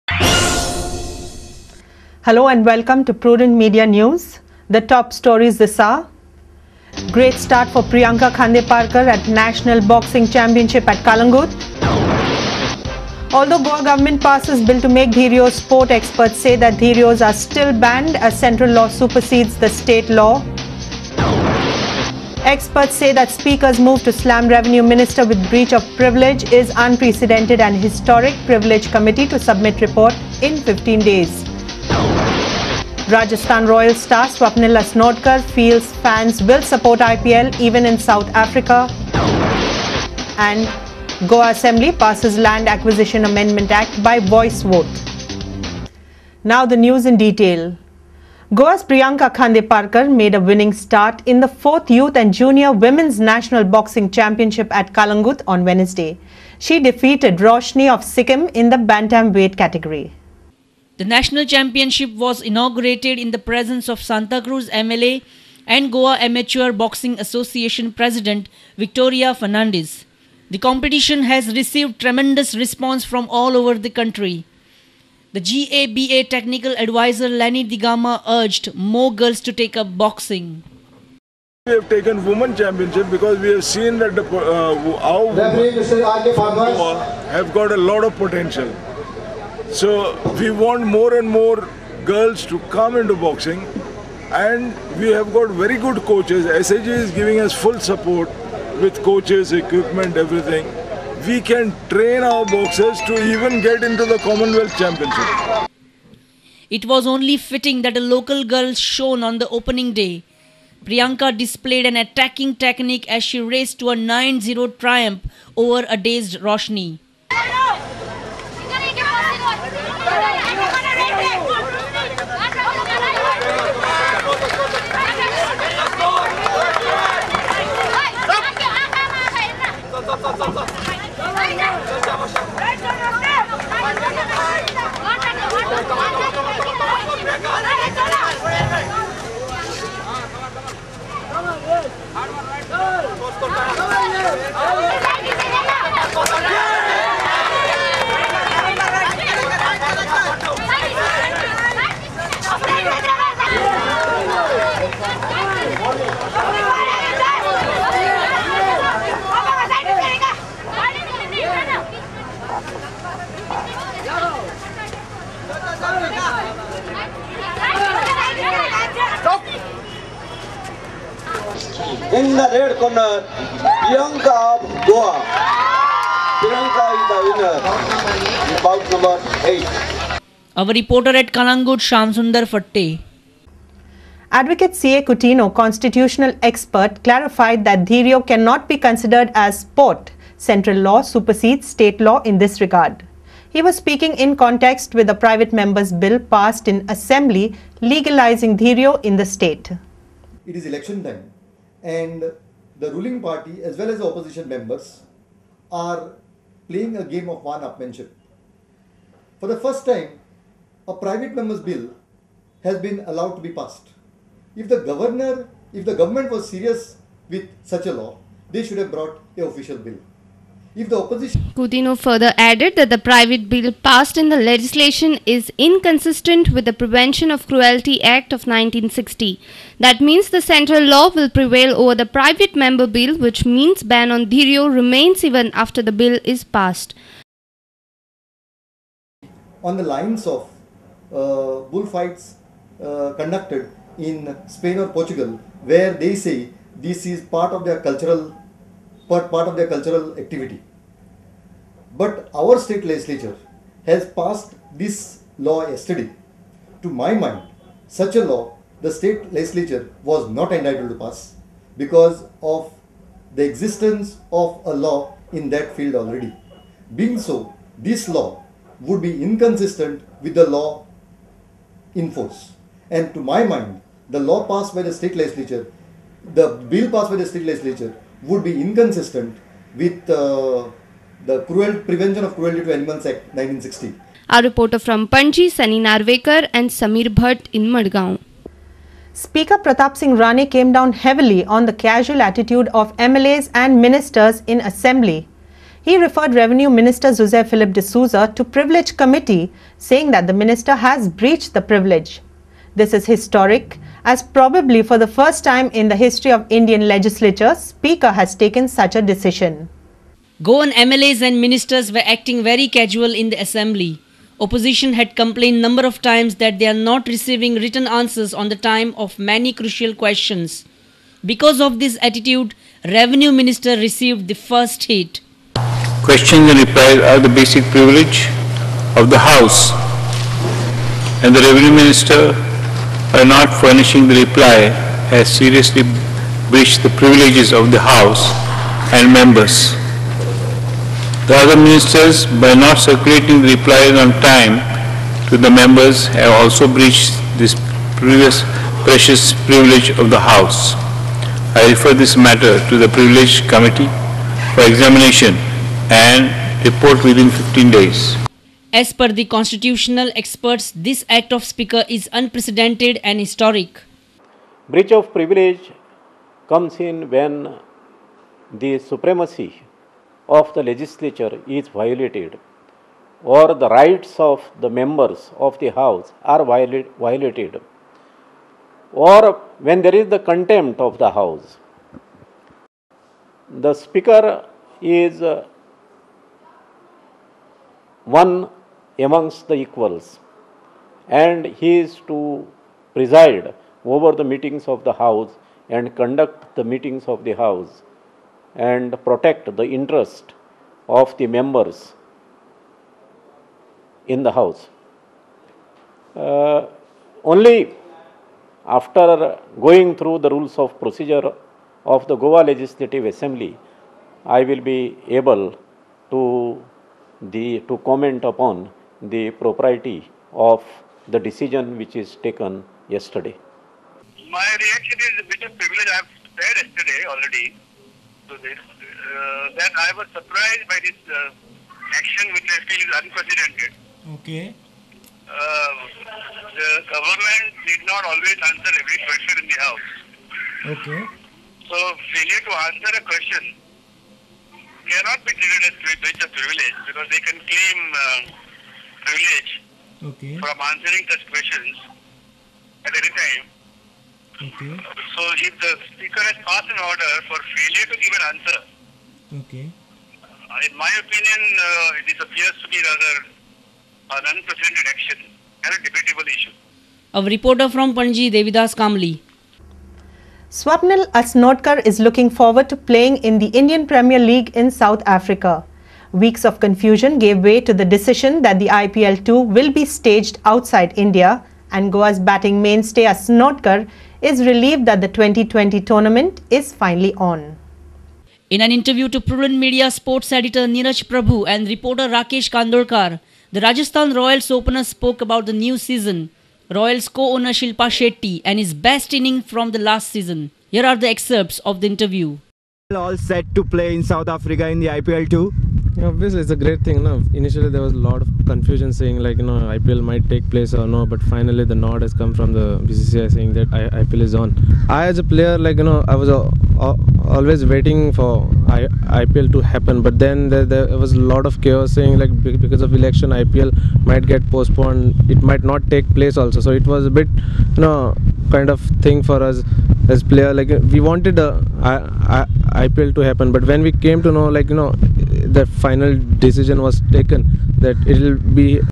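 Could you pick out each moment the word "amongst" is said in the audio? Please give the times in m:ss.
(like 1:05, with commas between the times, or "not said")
6:29.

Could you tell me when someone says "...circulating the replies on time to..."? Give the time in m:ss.
5:42.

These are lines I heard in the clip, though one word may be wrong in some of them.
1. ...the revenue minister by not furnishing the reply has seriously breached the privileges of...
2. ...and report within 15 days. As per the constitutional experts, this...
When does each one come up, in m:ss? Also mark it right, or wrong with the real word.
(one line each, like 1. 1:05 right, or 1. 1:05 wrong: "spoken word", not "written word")
1. 5:31 right
2. 5:55 right.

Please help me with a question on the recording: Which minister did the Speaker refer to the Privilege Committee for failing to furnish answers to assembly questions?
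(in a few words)
Jose Philip D'Souza.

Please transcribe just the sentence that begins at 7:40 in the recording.
Uh, in my opinion, uh, this appears to be rather an unprecedented action and a debatable issue.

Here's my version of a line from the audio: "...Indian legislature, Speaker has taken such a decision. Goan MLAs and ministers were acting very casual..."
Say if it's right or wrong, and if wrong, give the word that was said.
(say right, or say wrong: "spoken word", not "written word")
right.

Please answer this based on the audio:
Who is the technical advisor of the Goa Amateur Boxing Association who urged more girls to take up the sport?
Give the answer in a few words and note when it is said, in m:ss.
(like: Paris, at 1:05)
Lenny Digama, at 1:17.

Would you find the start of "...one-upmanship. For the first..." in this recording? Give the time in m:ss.
3:27.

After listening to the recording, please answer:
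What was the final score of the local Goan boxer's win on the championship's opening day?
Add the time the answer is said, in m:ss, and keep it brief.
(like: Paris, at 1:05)
9-0, at 1:53.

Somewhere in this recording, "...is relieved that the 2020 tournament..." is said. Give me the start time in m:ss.
8:04.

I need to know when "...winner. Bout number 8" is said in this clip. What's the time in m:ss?
2:57.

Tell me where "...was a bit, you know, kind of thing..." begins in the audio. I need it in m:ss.
8:46.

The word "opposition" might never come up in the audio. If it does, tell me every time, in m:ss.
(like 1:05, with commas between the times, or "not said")
3:24, 3:40, 5:14.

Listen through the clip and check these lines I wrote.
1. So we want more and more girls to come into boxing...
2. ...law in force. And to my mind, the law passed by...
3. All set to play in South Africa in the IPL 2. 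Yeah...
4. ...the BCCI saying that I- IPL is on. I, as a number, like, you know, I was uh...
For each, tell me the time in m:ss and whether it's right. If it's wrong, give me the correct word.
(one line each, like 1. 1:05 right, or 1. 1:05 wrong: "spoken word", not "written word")
1. 1:29 right
2. 4:30 right
3. 8:22 right
4. 8:32 wrong: "player", not "number".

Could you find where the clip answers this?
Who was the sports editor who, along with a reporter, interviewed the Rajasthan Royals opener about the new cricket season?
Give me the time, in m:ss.
8:10.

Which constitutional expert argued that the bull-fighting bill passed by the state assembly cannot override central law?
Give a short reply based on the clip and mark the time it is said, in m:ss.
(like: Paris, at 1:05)
C.A. Coutinho, at 3:04.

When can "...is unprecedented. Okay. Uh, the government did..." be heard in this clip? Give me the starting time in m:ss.
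7:12.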